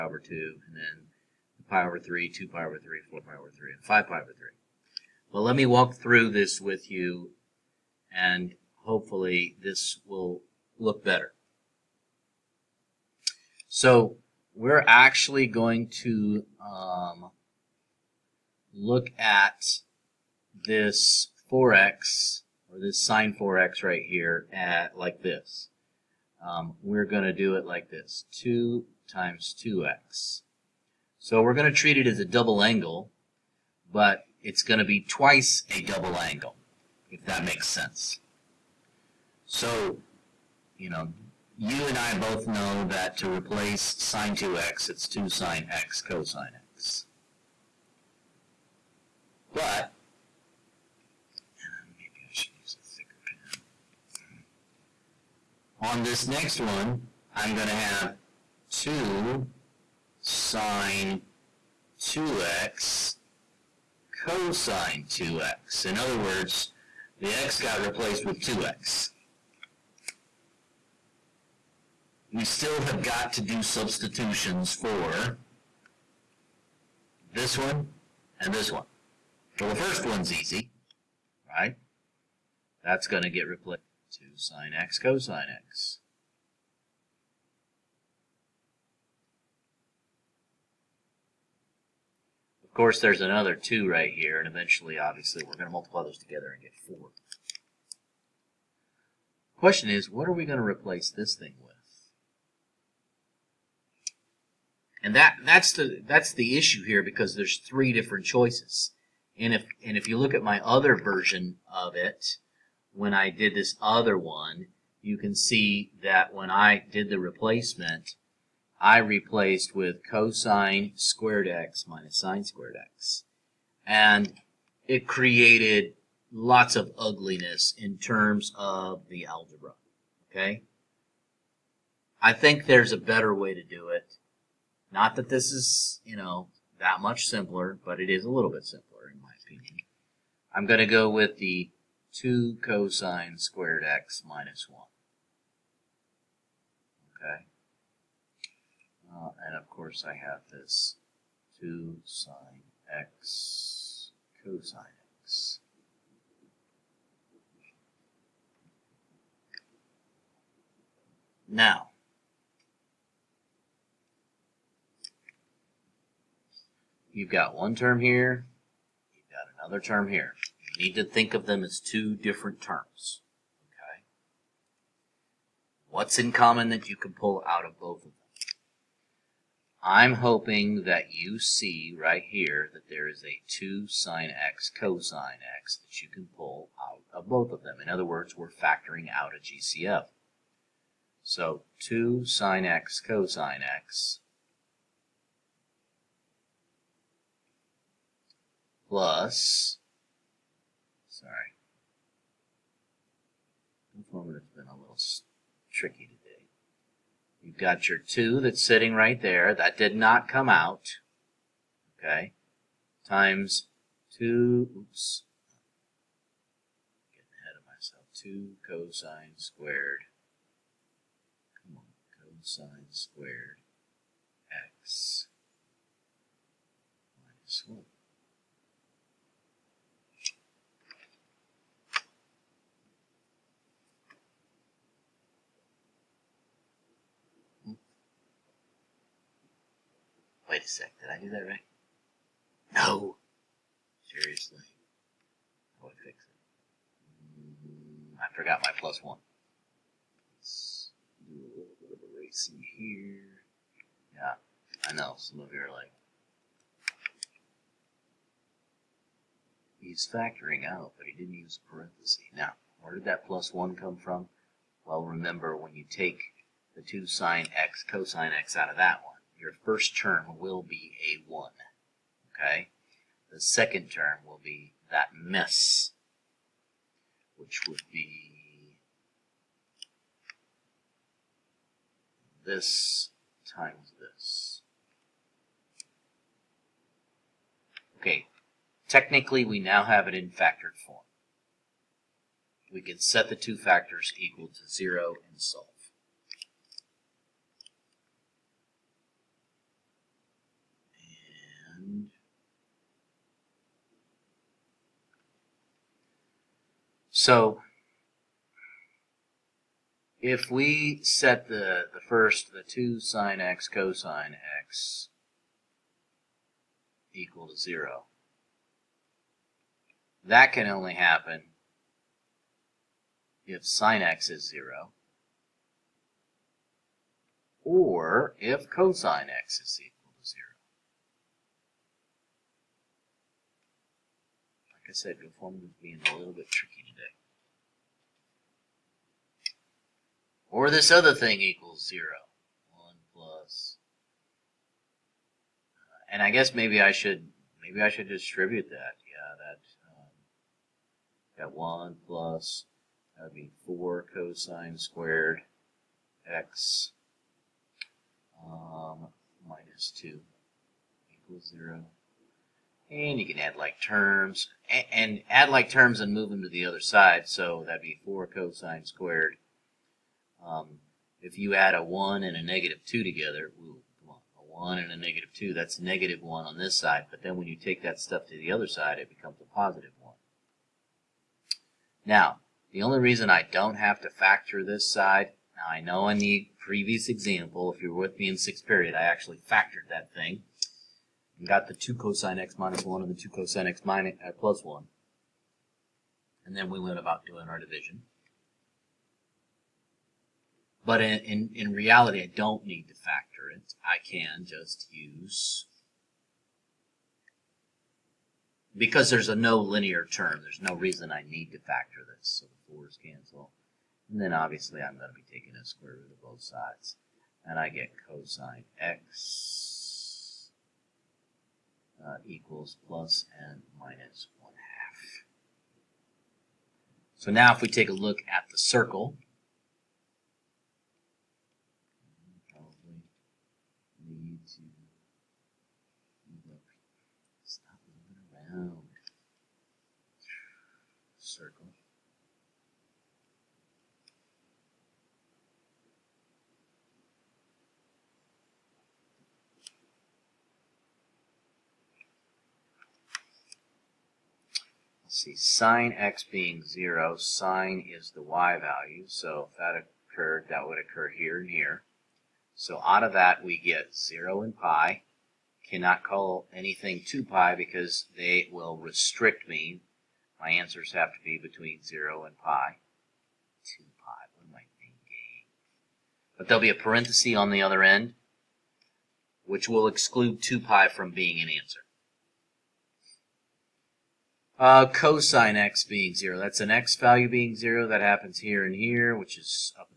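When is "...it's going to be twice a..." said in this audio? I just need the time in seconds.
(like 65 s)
34 s.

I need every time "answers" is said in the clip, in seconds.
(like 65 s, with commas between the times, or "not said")
470 s, 481 s.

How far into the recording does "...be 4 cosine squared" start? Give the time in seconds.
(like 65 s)
367 s.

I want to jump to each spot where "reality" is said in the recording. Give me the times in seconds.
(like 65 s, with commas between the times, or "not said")
401 s.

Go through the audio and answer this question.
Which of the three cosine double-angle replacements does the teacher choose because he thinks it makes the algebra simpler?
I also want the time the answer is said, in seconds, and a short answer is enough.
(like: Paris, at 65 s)
2 cosine squared x minus 1, at 142 s.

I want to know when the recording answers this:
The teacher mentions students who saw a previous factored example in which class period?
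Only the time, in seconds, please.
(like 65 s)
388 s.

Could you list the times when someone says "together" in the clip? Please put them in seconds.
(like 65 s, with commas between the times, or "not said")
96 s, 373 s.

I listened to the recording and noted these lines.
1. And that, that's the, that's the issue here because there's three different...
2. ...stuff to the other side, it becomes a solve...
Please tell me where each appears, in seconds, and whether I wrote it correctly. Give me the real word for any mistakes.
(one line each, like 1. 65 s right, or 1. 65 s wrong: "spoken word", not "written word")
1. 105 s right
2. 377 s wrong: "positive", not "solve".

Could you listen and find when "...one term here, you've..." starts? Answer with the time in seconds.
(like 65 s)
167 s.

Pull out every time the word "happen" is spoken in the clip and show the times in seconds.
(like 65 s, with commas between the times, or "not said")
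320 s, 488 s.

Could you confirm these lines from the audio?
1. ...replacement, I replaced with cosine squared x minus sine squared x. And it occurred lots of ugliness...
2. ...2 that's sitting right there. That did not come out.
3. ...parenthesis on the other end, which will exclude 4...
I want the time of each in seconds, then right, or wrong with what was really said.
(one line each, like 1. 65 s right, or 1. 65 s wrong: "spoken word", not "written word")
1. 117 s wrong: "created", not "occurred"
2. 207 s right
3. 476 s wrong: "2", not "4".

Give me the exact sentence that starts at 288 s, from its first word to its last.
Okay, technically we now have it in factored form.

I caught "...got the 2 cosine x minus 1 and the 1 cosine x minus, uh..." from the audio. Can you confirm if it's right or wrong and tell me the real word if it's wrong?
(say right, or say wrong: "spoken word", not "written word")
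wrong: "2", not "1".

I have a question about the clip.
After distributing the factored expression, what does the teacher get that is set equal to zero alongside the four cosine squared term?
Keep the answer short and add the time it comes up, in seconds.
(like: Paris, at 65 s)
minus 2, at 359 s.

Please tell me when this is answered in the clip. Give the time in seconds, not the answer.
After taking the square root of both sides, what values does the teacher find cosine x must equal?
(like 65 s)
422 s.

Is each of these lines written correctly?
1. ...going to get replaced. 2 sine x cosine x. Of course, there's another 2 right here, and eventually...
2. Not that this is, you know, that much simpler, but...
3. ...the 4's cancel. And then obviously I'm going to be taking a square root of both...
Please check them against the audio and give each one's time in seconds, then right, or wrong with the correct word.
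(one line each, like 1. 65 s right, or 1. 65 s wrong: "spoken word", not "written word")
1. 83 s right
2. 134 s right
3. 412 s right.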